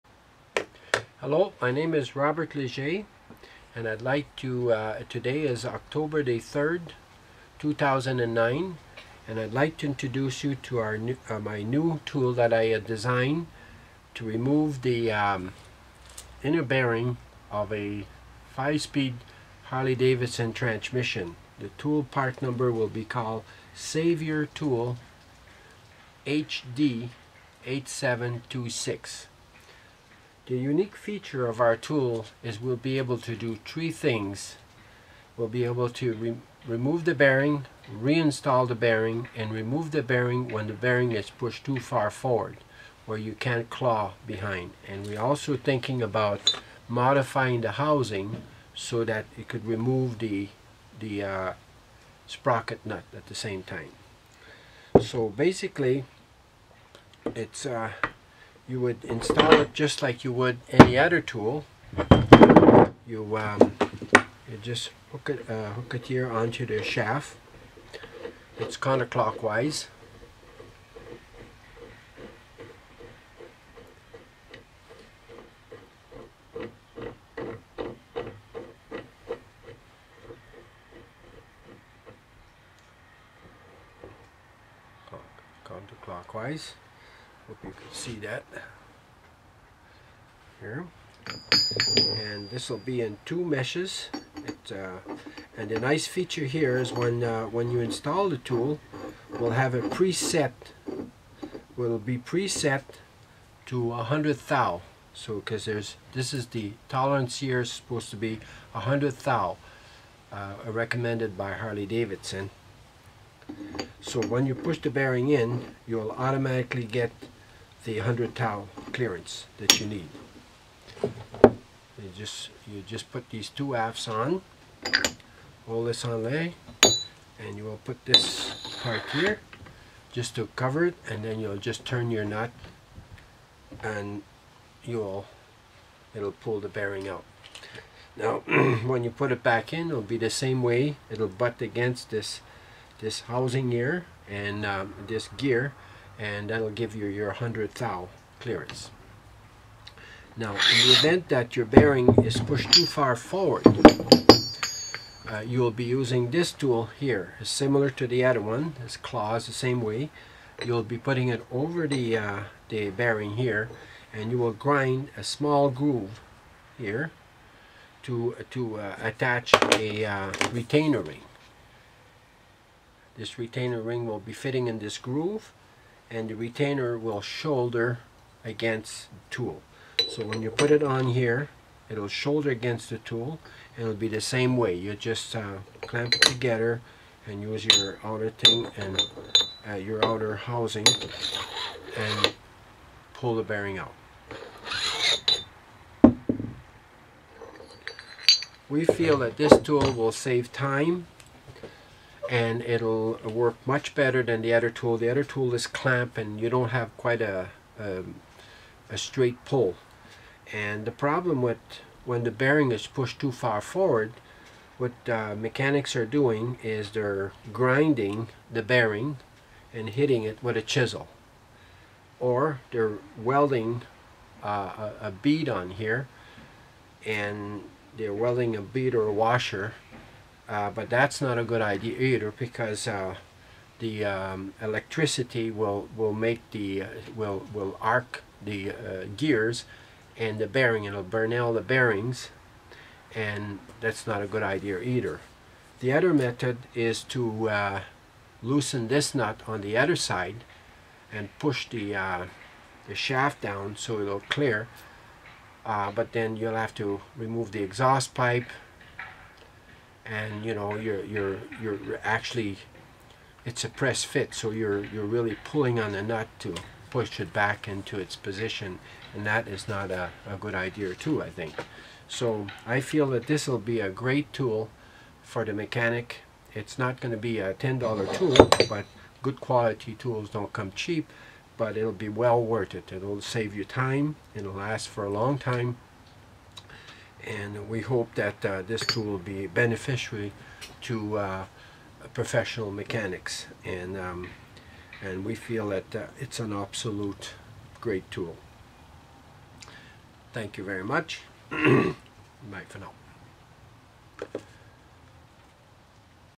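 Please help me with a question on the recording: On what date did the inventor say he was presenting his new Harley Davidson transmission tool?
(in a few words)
October 3, 2009.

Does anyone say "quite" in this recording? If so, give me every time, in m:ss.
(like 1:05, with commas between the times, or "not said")
3:26.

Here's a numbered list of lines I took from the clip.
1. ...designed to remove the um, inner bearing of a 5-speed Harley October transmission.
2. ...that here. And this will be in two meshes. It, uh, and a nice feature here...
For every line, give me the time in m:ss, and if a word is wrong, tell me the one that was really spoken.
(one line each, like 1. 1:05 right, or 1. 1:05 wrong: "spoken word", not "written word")
1. 0:12 wrong: "Davidson", not "October"
2. 1:28 right.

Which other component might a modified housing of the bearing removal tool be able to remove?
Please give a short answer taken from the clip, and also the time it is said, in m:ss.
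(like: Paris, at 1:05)
sprocket nut, at 0:52.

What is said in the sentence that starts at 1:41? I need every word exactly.
Will be preset to 100 thou.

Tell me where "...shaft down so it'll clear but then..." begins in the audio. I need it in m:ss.
4:12.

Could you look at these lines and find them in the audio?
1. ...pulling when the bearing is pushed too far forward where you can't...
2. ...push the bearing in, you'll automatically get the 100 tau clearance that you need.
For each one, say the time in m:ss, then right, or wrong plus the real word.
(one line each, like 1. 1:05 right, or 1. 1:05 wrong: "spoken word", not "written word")
1. 0:40 wrong: "bearing", not "pulling"
2. 1:54 right.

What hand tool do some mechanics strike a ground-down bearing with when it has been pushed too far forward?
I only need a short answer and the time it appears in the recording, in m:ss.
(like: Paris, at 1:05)
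chisel, at 3:40.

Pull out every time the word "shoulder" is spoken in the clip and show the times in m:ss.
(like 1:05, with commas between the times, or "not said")
2:57, 3:02.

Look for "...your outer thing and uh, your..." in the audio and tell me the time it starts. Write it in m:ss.
3:07.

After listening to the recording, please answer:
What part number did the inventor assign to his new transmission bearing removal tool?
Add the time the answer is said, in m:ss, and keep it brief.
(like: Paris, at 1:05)
Savior Tool HD 8726, at 0:23.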